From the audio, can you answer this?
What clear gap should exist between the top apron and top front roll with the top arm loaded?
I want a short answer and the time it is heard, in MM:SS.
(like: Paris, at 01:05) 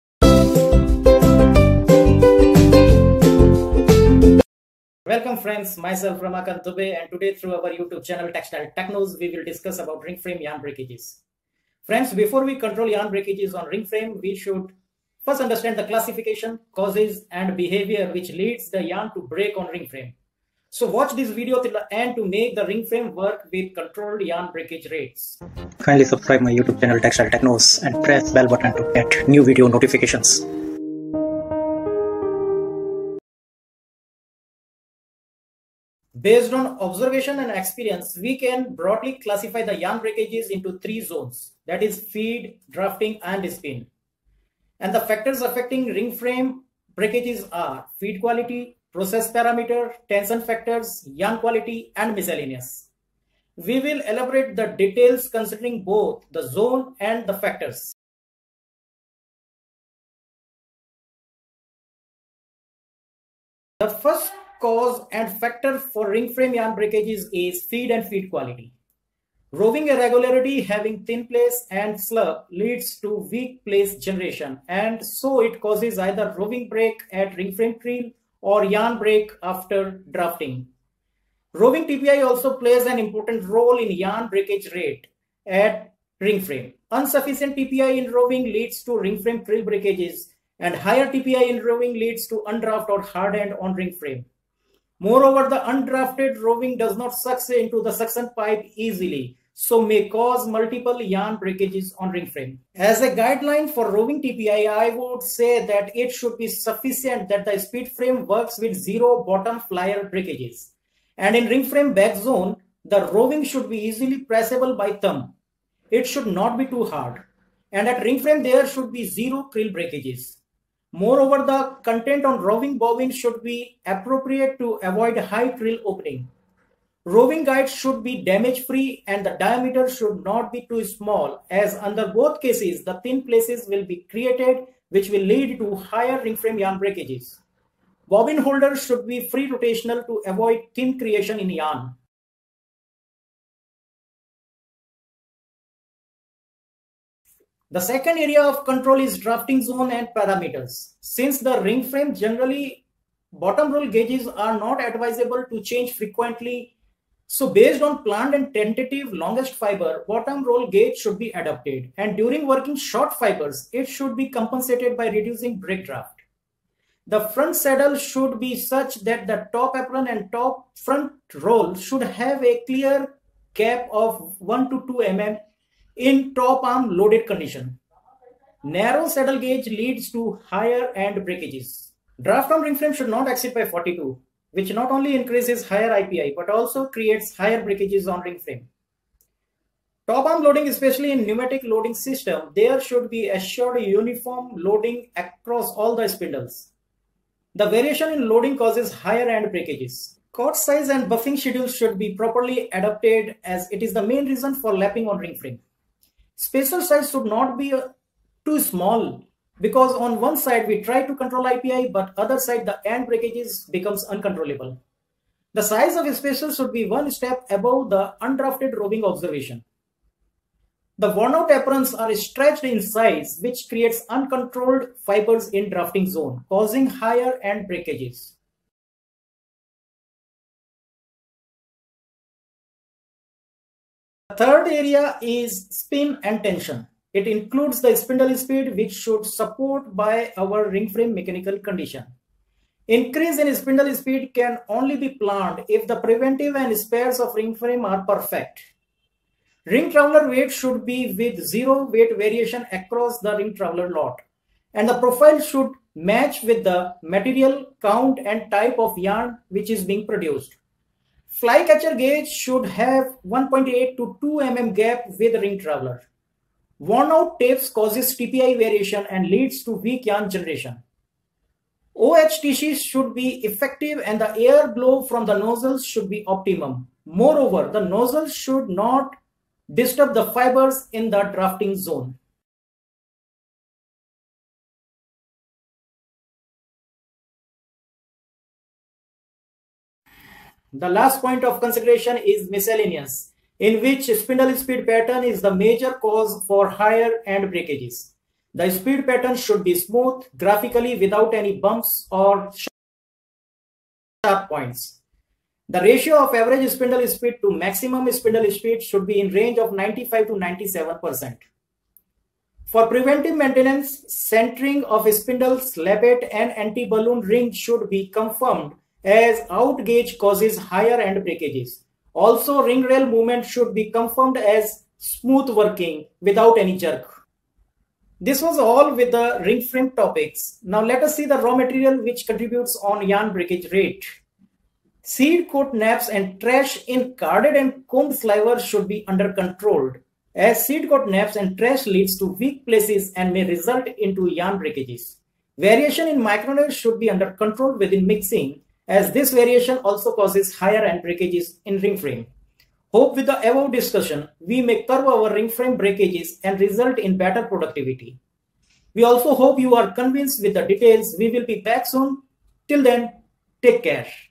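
1 to 2 mm, at 02:54.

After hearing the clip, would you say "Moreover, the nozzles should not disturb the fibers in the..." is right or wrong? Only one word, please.
right.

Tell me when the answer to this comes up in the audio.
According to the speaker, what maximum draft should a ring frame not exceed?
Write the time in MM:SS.
03:03.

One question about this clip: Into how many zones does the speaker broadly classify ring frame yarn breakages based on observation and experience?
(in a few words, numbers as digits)
3.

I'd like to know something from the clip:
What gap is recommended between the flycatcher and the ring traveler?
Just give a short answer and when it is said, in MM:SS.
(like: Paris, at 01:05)
1.8 to 2 mm, at 04:23.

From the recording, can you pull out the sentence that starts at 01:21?
Roving TPI also plays an important role in yarn breakage rate at ring frame.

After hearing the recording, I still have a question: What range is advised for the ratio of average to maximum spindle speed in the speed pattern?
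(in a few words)
95 to 97%.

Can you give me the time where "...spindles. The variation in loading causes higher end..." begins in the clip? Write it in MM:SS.
03:16.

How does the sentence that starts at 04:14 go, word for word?
And the profile should match with the material count and type of yarn which is being produced.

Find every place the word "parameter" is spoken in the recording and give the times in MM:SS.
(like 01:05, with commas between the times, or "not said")
00:49, 02:30.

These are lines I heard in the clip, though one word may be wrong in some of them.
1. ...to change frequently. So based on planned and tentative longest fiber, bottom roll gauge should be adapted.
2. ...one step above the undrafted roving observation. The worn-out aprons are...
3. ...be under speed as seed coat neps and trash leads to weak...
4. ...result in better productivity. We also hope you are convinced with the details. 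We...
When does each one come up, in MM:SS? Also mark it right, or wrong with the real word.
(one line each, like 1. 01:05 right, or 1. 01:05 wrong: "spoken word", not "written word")
1. 02:35 right
2. 03:36 right
3. 05:38 wrong: "controlled", not "speed"
4. 05:56 right.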